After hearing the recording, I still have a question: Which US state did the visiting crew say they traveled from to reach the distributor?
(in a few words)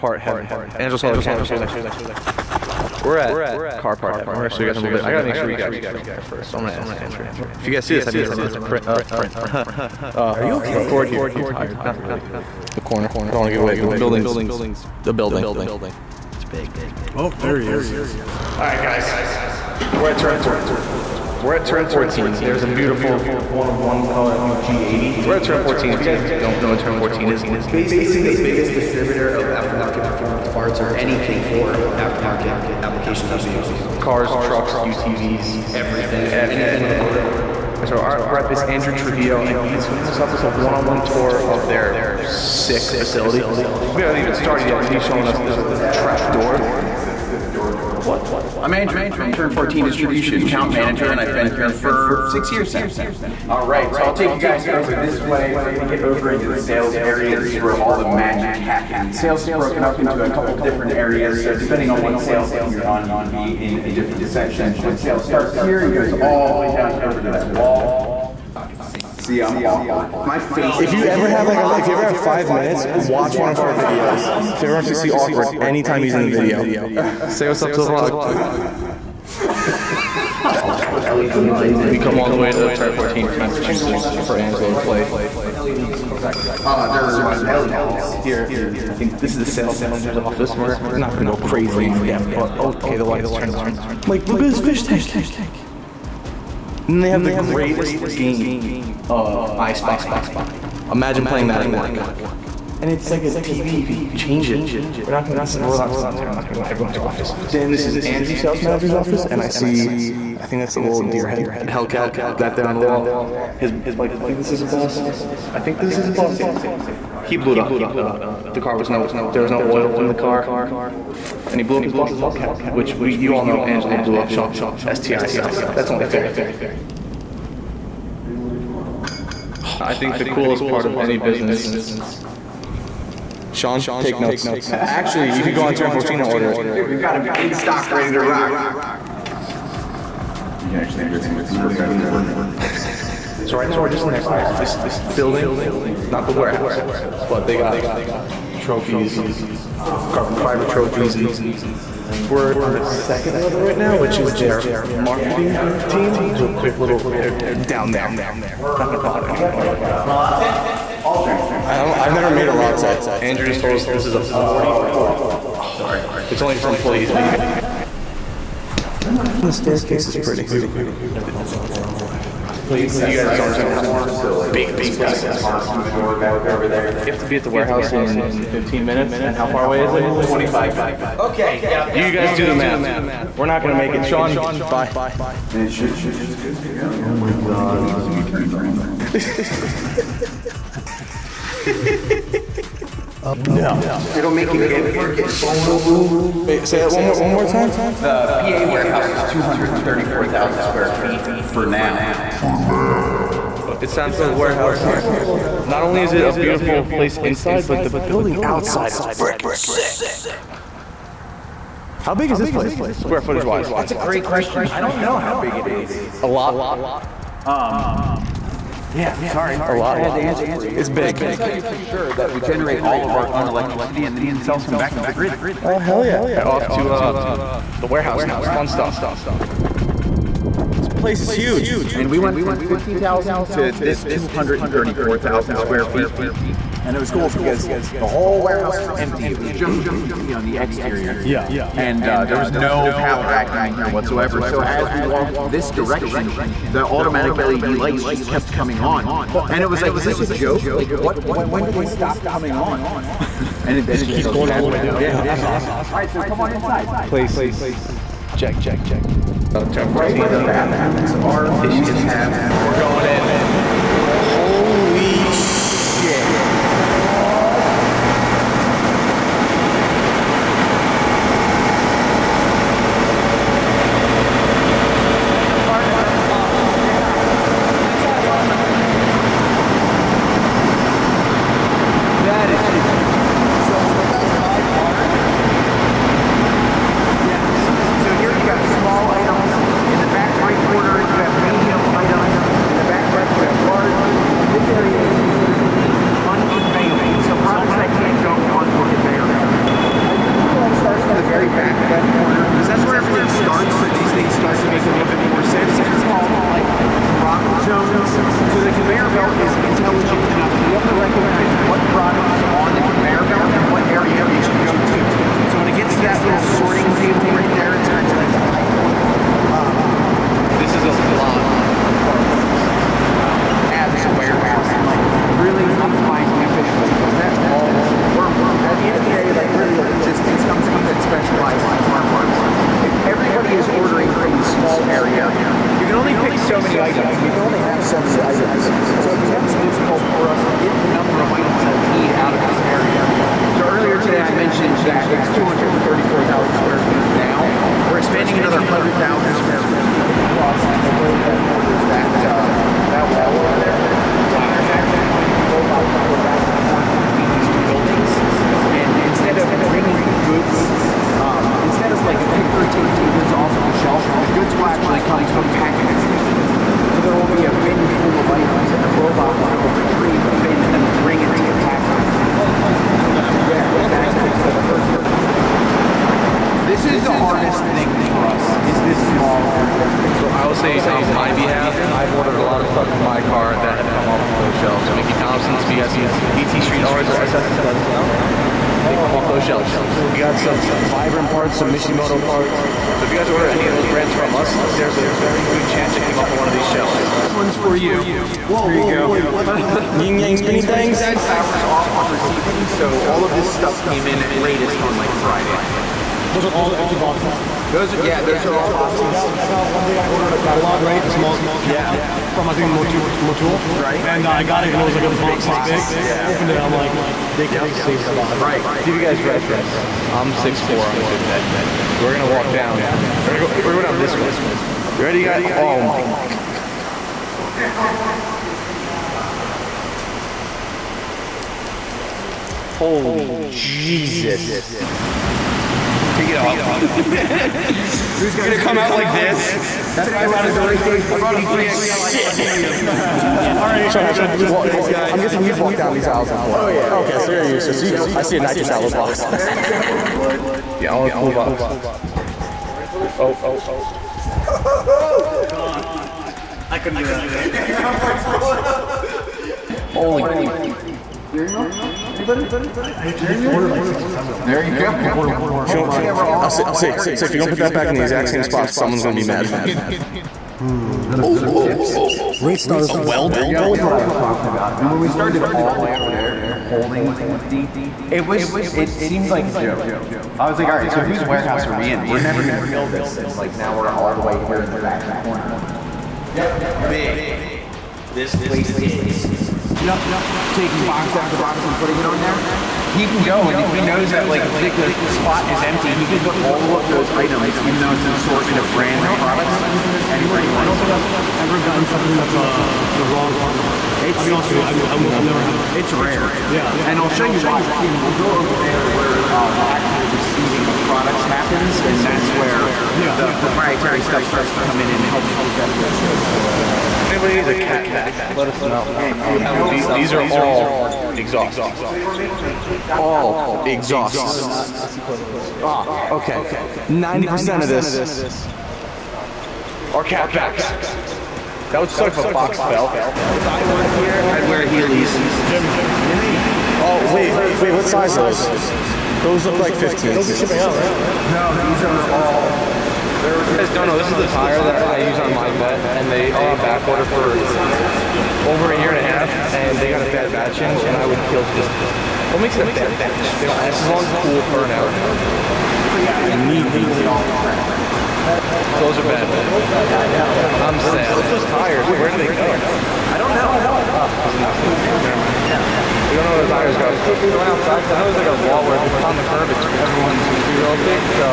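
Massachusetts.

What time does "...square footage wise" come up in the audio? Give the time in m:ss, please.
3:32.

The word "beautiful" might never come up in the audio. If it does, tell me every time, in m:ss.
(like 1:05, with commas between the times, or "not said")
0:22, 2:50, 3:26.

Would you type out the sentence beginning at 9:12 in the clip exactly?
What makes it a bad batch?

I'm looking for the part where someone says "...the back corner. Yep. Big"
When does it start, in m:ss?
8:04.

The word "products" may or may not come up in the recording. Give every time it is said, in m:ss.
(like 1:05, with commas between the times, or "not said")
8:19, 8:30.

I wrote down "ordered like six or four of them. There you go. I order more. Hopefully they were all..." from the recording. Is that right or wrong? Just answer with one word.
wrong.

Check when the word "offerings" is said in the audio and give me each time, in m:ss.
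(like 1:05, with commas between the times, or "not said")
not said.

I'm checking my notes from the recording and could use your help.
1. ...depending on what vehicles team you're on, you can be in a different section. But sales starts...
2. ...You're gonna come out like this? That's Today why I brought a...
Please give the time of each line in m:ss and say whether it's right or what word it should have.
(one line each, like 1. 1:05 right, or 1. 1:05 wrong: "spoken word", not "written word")
1. 1:01 wrong: "sales", not "vehicles"
2. 7:18 right.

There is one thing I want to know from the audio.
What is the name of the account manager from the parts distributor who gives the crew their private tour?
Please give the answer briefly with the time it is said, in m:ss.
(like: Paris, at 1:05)
Andrew Trujillo, at 0:38.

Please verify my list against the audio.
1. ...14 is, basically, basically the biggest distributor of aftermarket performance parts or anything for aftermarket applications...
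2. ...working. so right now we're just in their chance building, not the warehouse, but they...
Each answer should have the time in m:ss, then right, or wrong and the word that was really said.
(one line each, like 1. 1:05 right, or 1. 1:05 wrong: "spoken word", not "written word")
1. 0:26 right
2. 2:23 wrong: "office", not "chance".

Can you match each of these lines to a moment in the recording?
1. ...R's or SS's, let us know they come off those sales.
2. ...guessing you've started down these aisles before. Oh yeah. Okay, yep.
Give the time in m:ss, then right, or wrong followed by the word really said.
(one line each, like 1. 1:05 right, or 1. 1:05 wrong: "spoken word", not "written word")
1. 6:26 wrong: "shelves", not "sales"
2. 7:25 wrong: "walked", not "started".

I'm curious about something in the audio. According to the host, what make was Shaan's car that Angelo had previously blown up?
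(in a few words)
STI.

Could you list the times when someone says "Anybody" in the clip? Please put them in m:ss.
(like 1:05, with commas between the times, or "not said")
7:42, 8:37.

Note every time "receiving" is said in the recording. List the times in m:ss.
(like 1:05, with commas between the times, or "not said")
6:42, 8:30.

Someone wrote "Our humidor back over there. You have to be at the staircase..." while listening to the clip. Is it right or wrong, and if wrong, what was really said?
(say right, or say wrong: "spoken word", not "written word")
wrong: "warehouse", not "staircase".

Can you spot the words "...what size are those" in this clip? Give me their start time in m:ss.
8:57.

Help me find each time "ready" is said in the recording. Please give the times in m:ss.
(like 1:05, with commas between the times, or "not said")
2:17, 7:05.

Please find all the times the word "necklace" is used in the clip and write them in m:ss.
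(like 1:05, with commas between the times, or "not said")
not said.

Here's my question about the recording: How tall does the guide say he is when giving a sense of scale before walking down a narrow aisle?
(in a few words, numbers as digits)
6'4.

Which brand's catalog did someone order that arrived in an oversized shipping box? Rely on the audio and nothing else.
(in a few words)
Motul.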